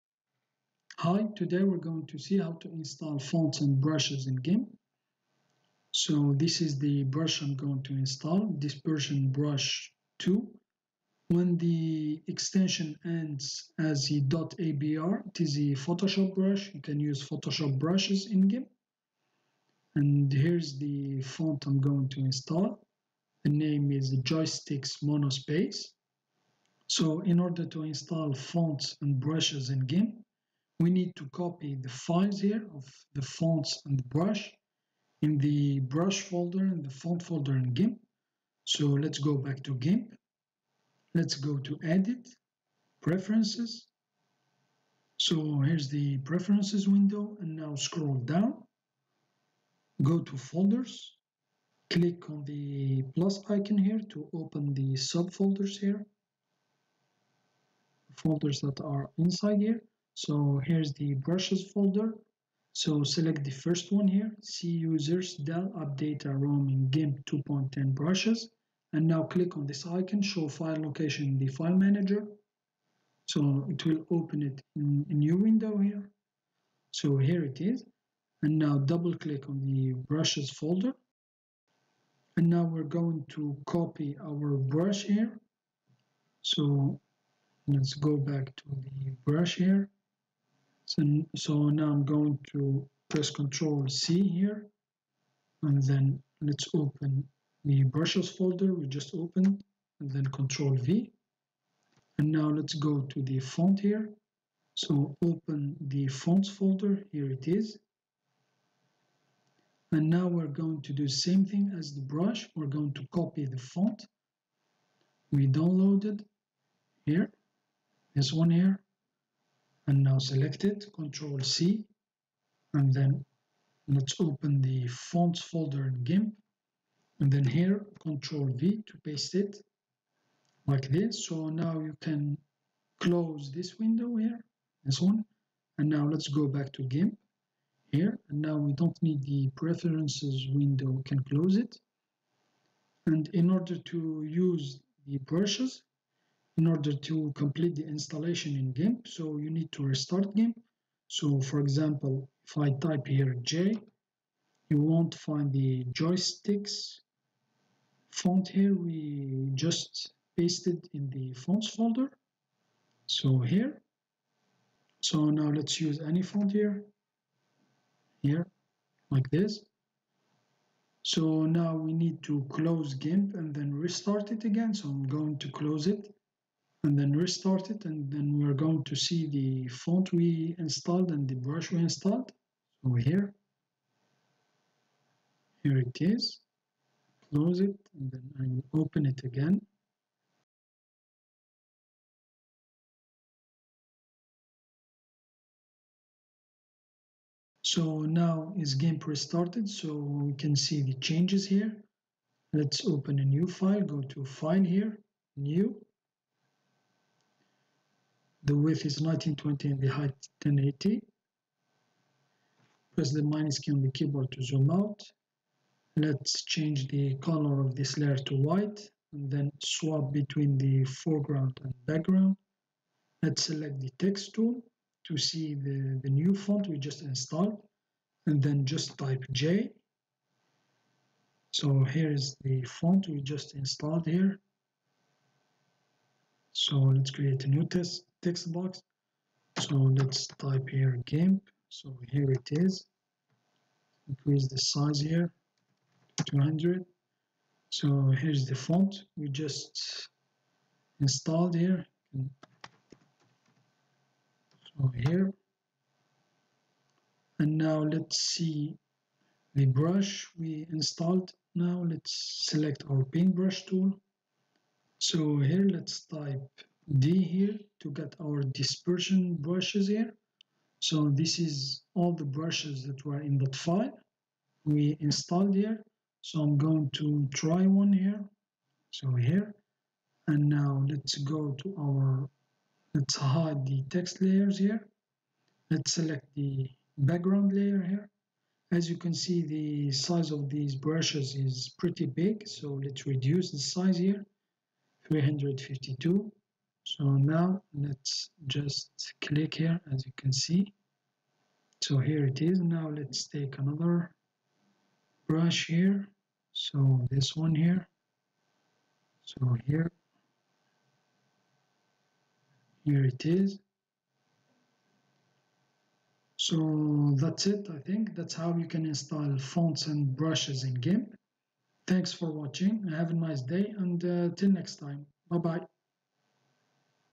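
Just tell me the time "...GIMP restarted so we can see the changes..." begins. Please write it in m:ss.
3:18.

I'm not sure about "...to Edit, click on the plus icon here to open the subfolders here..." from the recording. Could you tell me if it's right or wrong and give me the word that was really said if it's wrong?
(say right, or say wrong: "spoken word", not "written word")
wrong: "Folders", not "Edit".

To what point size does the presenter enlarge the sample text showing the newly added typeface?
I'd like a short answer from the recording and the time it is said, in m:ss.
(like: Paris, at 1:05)
200, at 4:06.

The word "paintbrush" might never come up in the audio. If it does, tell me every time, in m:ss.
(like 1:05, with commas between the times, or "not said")
4:23.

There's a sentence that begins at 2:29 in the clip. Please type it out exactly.
So you need to restart GIMP.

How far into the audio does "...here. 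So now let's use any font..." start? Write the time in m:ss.
2:43.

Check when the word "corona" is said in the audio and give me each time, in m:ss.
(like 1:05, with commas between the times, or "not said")
not said.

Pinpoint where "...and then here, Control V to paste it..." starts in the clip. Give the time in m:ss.
2:07.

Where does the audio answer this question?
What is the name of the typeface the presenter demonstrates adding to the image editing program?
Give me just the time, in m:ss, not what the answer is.
0:24.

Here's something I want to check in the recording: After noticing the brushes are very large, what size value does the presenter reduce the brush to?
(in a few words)
352.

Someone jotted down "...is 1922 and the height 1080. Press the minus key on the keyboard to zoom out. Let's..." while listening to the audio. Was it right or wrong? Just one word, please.
wrong.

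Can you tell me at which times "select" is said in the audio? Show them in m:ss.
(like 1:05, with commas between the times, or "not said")
1:03, 2:00, 3:43, 4:22, 4:45.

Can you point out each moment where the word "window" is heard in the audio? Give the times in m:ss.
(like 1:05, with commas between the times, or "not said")
0:46, 1:15, 2:13, 2:20.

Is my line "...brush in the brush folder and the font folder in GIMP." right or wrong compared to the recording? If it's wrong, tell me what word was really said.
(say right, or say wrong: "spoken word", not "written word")
right.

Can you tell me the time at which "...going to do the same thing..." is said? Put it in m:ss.
1:50.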